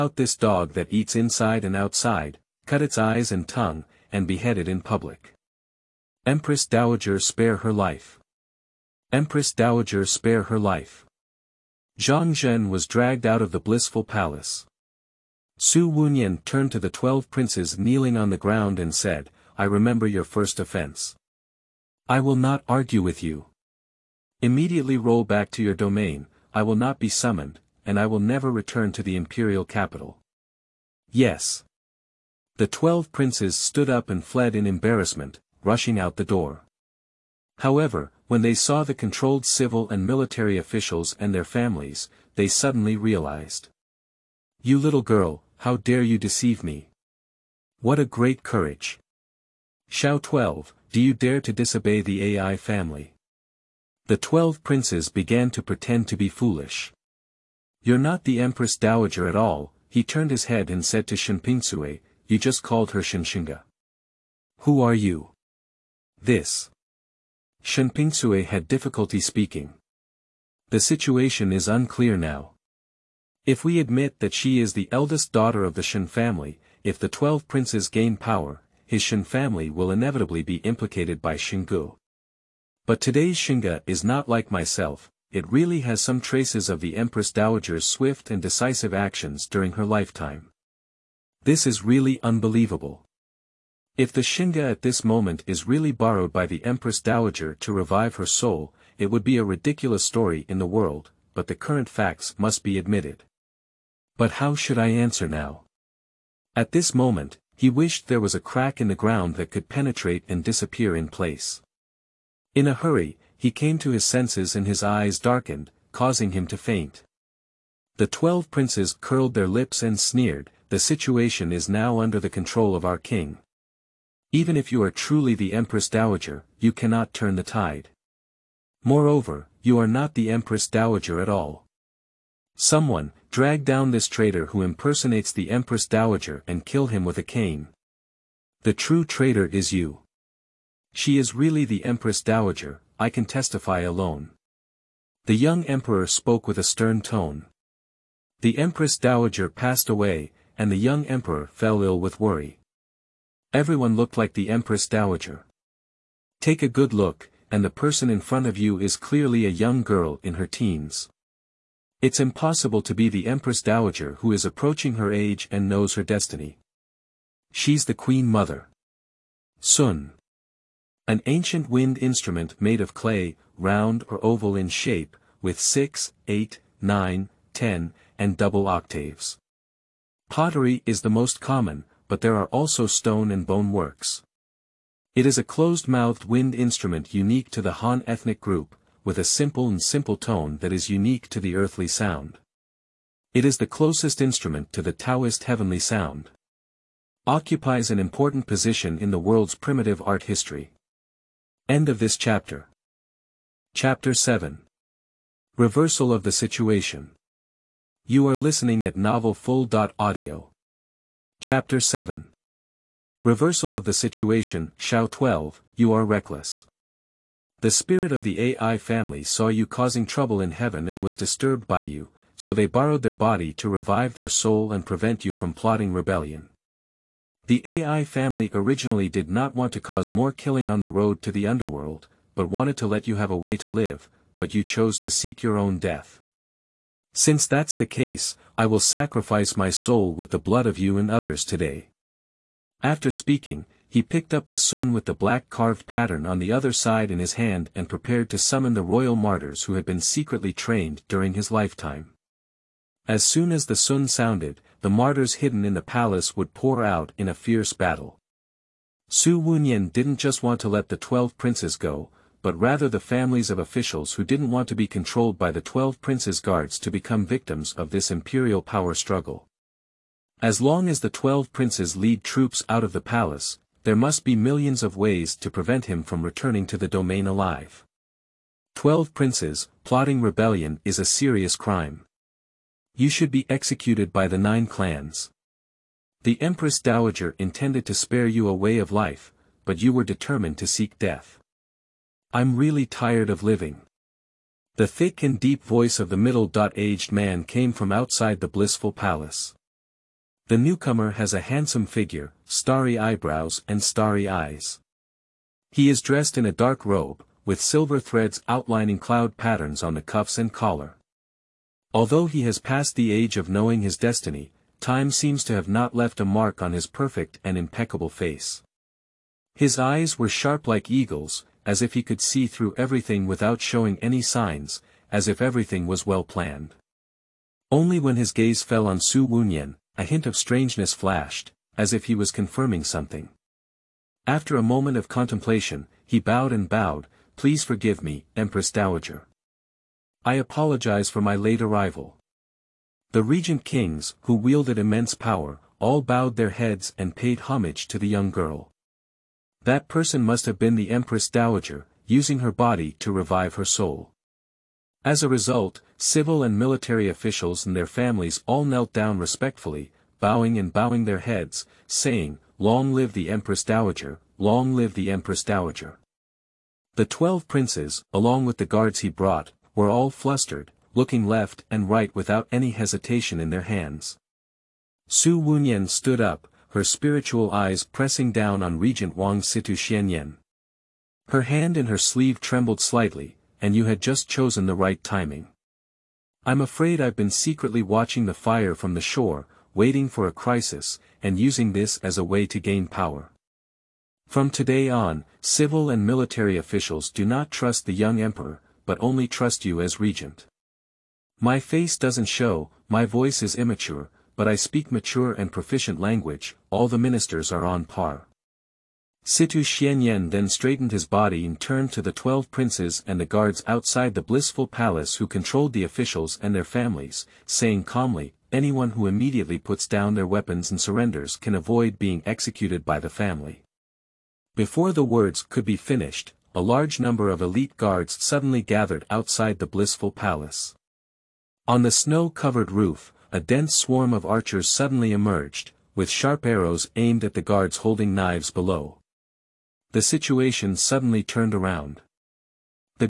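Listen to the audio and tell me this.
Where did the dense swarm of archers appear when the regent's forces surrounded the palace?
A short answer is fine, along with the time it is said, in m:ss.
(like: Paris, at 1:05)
On the snow-covered roof, at 7:11.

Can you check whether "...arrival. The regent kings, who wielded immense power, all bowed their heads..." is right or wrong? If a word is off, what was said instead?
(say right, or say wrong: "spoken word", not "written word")
right.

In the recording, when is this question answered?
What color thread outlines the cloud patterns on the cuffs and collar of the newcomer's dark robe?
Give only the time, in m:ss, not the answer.
5:07.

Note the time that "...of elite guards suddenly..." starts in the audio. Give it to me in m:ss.
7:07.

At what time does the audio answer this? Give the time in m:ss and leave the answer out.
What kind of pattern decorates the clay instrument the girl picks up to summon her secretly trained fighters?
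4:05.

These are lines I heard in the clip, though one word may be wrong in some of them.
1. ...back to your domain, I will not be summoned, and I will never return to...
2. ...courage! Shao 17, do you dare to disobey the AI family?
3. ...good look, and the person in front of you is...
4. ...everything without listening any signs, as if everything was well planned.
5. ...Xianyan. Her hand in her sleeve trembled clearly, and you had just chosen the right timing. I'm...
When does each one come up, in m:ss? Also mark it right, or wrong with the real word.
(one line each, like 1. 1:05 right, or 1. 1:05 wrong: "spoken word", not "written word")
1. 0:25 right
2. 0:48 wrong: "12", not "17"
3. 2:36 right
4. 5:22 wrong: "showing", not "listening"
5. 6:19 wrong: "slightly", not "clearly".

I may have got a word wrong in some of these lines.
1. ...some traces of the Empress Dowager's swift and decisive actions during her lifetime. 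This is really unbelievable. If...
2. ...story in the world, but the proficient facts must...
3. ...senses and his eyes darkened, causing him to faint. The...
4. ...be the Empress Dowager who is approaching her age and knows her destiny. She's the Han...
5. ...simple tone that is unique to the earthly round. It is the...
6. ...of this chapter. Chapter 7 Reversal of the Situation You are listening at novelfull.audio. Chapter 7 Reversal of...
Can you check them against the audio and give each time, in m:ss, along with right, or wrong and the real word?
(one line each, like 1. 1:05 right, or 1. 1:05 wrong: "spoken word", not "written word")
1. 1:26 right
2. 1:40 wrong: "current", not "proficient"
3. 1:54 right
4. 2:42 wrong: "Queen", not "Han"
5. 3:09 wrong: "sound", not "round"
6. 3:21 right.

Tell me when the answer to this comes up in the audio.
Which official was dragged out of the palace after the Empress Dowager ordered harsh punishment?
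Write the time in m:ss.
0:11.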